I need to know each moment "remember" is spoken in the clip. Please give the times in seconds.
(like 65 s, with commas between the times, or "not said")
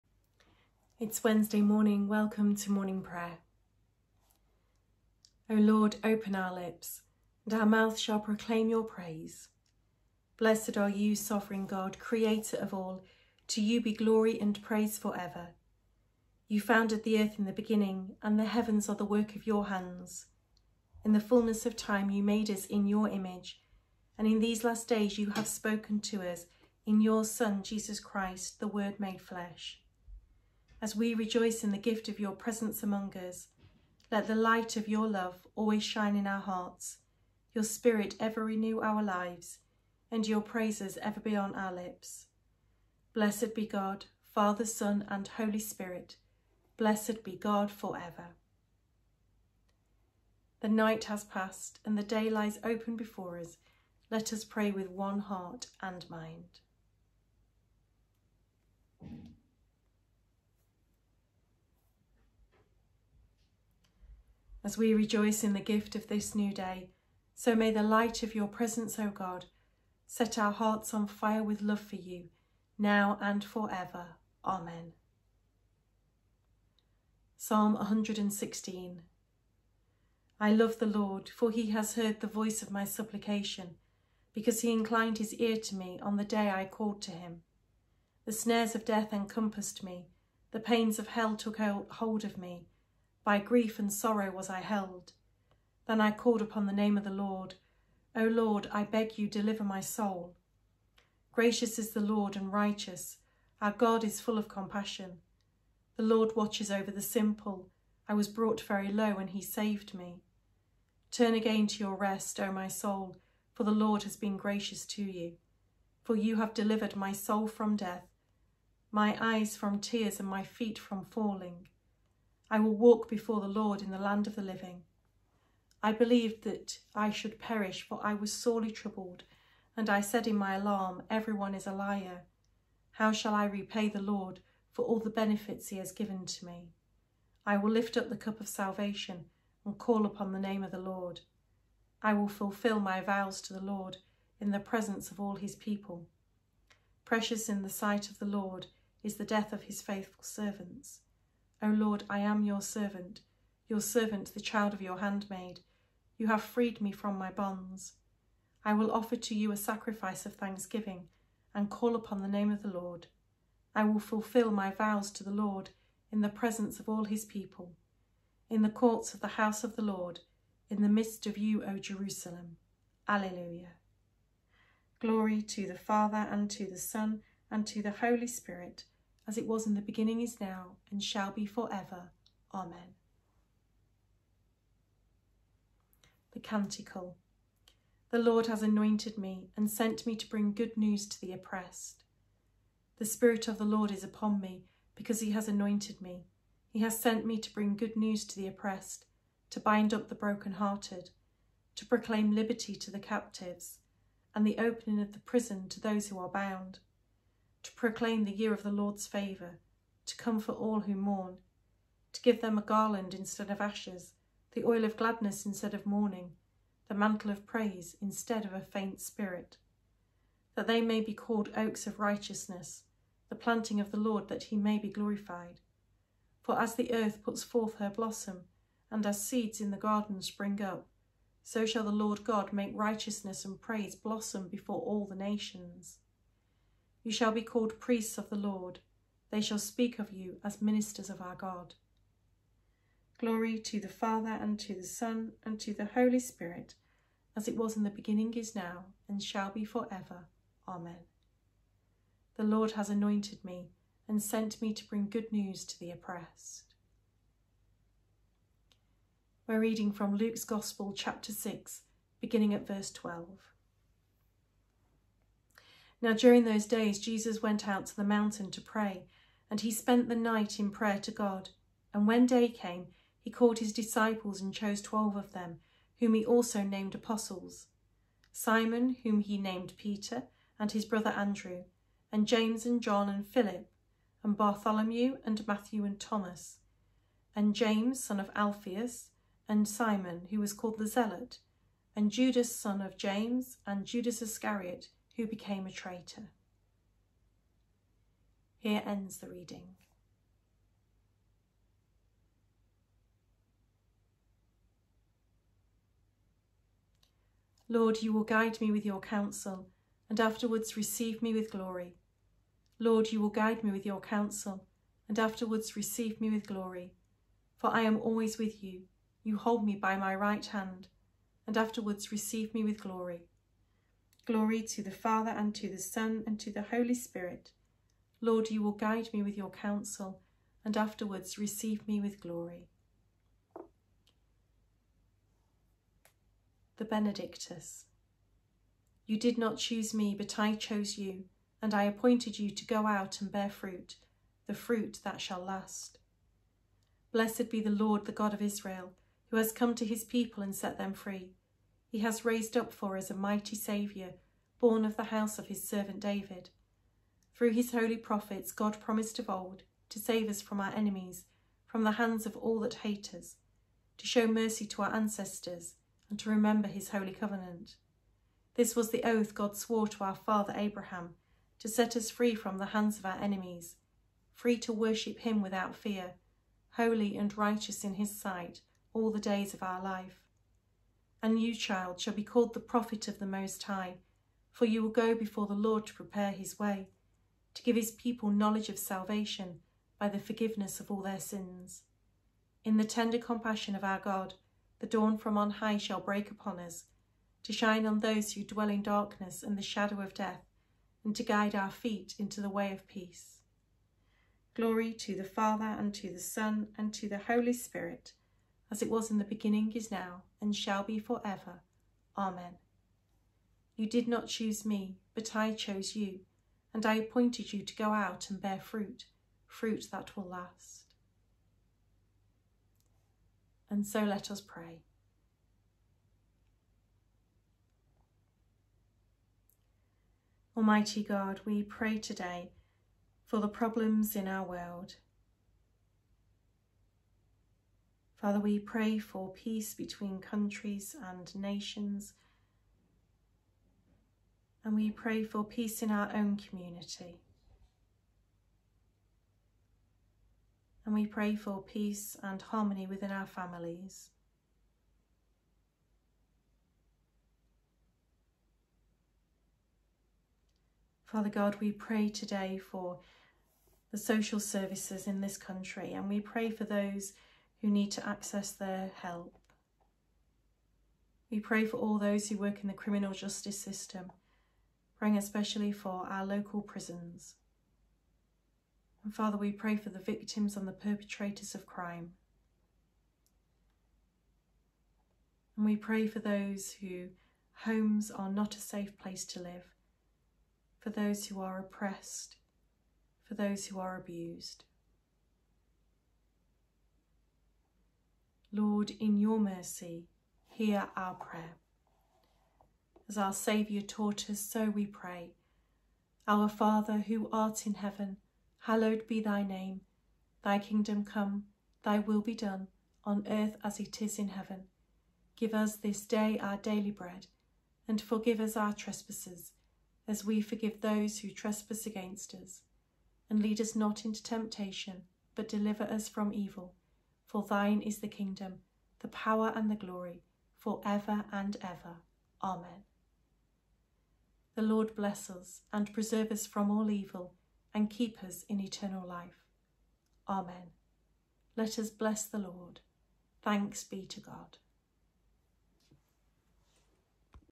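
366 s.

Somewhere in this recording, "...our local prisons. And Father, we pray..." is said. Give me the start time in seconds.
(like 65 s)
476 s.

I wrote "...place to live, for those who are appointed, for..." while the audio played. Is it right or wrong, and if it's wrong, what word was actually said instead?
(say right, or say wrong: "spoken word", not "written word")
wrong: "oppressed", not "appointed".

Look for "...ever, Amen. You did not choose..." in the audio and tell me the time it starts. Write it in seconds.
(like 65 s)
411 s.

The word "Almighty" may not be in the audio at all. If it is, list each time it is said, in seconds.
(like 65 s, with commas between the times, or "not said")
430 s.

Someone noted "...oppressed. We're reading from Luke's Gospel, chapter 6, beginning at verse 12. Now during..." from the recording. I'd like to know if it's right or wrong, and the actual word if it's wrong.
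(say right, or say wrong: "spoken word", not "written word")
right.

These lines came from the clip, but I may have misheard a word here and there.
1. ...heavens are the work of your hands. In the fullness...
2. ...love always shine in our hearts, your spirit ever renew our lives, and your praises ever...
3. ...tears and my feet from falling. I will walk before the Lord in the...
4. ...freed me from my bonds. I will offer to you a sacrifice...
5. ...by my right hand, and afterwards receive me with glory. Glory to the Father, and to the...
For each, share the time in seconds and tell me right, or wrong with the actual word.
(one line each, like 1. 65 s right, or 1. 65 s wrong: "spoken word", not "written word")
1. 18 s right
2. 35 s right
3. 119 s right
4. 156 s right
5. 319 s right.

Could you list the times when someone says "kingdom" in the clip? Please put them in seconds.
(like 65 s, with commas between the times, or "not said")
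510 s, 528 s.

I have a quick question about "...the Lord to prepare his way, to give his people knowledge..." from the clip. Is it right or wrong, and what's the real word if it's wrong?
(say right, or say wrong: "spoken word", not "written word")
right.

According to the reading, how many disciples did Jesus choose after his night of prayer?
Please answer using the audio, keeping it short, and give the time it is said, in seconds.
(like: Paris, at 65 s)
12, at 274 s.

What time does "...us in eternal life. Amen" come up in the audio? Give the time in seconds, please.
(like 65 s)
538 s.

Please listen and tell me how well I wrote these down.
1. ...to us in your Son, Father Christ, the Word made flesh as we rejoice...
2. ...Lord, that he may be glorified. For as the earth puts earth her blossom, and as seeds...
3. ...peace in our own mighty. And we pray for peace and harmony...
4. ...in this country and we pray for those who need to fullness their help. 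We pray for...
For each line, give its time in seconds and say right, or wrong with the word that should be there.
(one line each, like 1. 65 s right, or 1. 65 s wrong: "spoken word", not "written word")
1. 26 s wrong: "Jesus", not "Father"
2. 223 s wrong: "forth", not "earth"
3. 445 s wrong: "community", not "mighty"
4. 465 s wrong: "access", not "fullness".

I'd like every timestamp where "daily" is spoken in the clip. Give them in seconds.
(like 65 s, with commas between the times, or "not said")
516 s.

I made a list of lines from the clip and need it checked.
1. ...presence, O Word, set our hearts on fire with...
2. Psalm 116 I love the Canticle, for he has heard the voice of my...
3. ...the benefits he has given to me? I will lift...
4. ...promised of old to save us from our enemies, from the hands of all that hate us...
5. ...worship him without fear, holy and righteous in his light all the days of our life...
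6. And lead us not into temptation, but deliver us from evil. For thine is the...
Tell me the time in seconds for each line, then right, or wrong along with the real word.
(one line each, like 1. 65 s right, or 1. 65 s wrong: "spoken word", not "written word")
1. 68 s wrong: "God", not "Word"
2. 77 s wrong: "Lord", not "Canticle"
3. 134 s right
4. 358 s right
5. 374 s wrong: "sight", not "light"
6. 523 s right.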